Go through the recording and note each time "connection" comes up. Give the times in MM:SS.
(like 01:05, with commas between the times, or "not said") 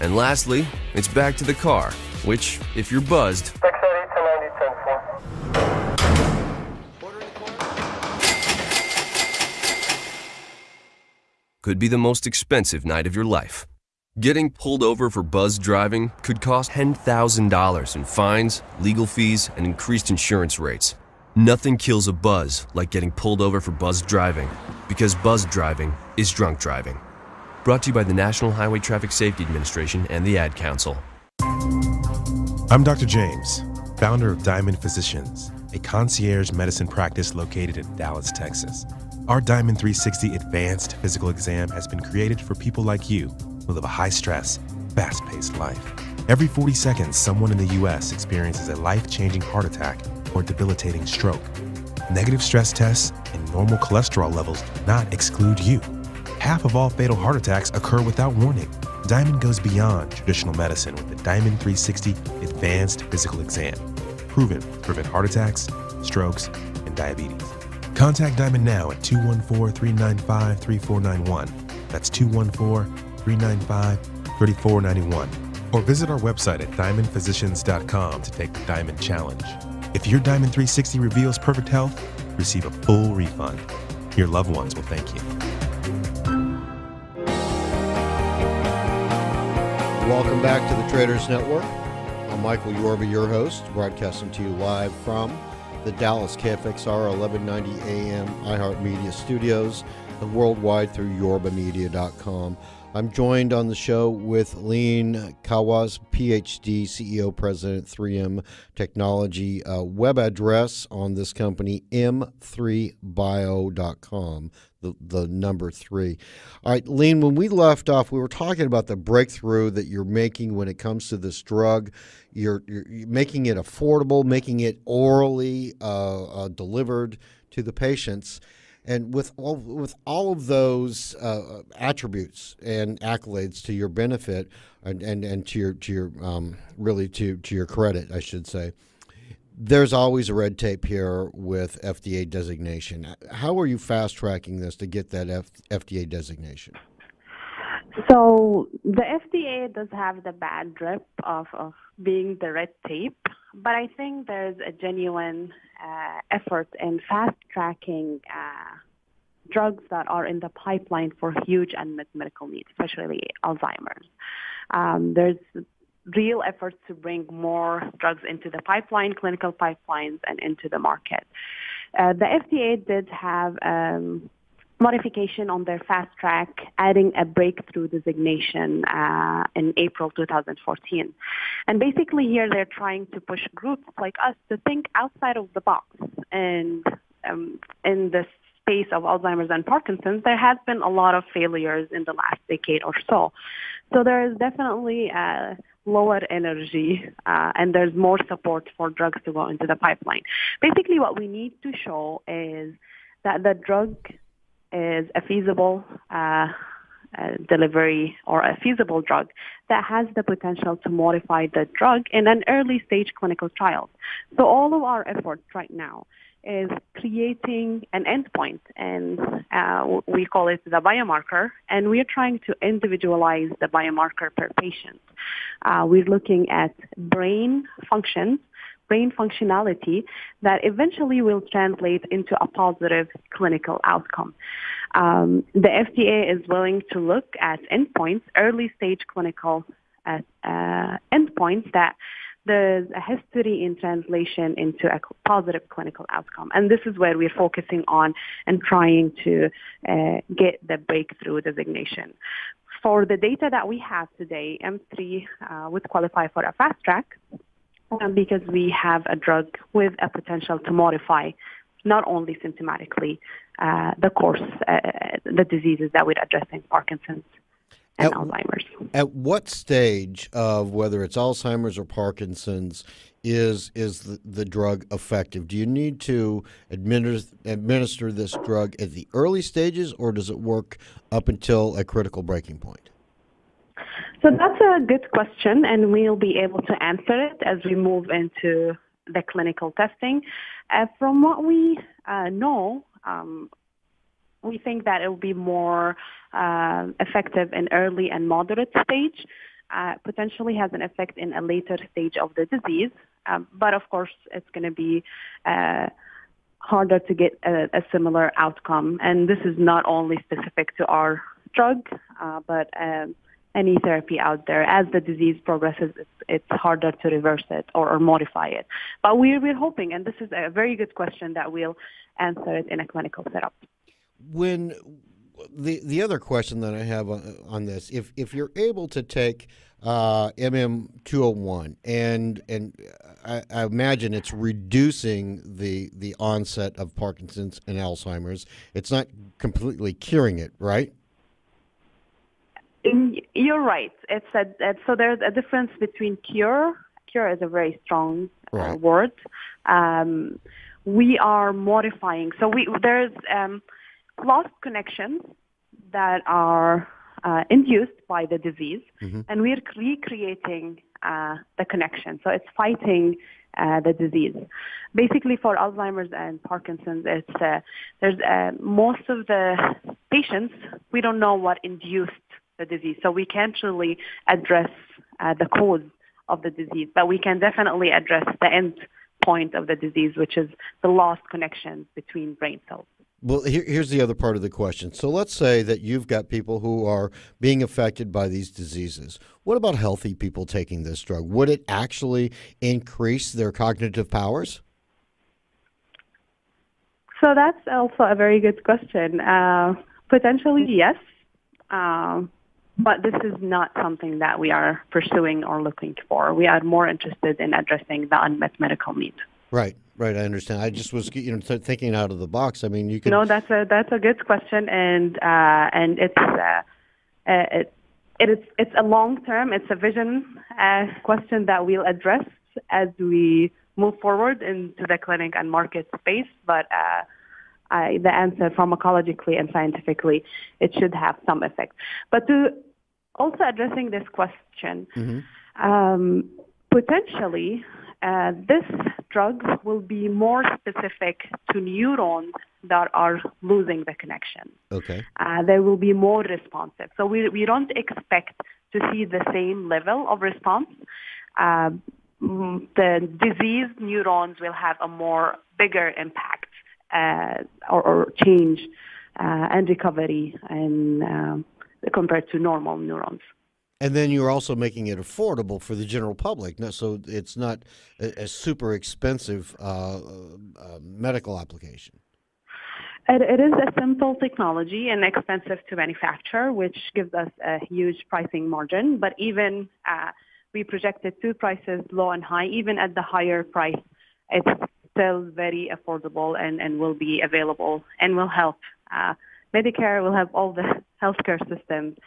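05:54, 06:01, 06:21, 07:23.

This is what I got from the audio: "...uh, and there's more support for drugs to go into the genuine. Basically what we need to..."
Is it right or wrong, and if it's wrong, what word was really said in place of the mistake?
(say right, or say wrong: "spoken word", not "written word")
wrong: "pipeline", not "genuine".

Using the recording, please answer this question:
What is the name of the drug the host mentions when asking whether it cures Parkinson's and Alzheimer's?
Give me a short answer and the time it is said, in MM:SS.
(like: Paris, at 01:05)
MM201, at 05:30.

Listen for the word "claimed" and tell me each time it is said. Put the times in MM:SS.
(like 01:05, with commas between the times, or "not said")
not said.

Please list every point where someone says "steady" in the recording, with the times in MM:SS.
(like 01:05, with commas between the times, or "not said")
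not said.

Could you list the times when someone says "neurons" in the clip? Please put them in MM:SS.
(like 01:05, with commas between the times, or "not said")
07:21, 07:33, 07:42.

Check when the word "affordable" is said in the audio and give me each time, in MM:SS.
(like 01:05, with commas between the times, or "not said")
02:03, 07:44, 08:05.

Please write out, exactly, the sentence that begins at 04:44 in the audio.
So that's a good question, and we'll be able to answer it as we move into the clinical testing.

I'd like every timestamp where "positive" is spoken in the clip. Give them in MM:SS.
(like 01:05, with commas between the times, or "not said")
03:52, 04:05.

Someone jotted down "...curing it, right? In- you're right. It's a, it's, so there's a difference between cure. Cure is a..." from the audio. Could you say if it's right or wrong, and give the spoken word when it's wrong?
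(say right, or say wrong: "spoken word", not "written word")
right.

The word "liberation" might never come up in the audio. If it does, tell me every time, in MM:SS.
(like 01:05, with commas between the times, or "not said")
not said.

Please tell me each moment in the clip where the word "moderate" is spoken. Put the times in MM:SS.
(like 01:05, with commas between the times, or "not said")
04:58.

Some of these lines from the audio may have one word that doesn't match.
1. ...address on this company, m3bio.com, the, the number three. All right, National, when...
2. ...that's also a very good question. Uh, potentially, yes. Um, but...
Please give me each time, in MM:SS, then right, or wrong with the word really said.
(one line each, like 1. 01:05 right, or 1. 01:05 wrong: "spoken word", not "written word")
1. 01:50 wrong: "Leen", not "National"
2. 06:37 right.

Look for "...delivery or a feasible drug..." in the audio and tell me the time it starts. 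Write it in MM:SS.
03:27.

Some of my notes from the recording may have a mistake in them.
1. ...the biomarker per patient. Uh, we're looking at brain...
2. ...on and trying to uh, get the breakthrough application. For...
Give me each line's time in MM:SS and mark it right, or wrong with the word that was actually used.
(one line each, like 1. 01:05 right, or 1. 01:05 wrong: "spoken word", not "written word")
1. 03:43 right
2. 04:07 wrong: "designation", not "application".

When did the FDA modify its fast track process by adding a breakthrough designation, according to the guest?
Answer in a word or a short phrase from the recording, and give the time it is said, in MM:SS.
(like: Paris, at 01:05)
April 2014, at 02:59.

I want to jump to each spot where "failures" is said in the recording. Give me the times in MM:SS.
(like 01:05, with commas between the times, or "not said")
03:11.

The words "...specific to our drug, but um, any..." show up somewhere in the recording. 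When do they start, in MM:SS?
05:10.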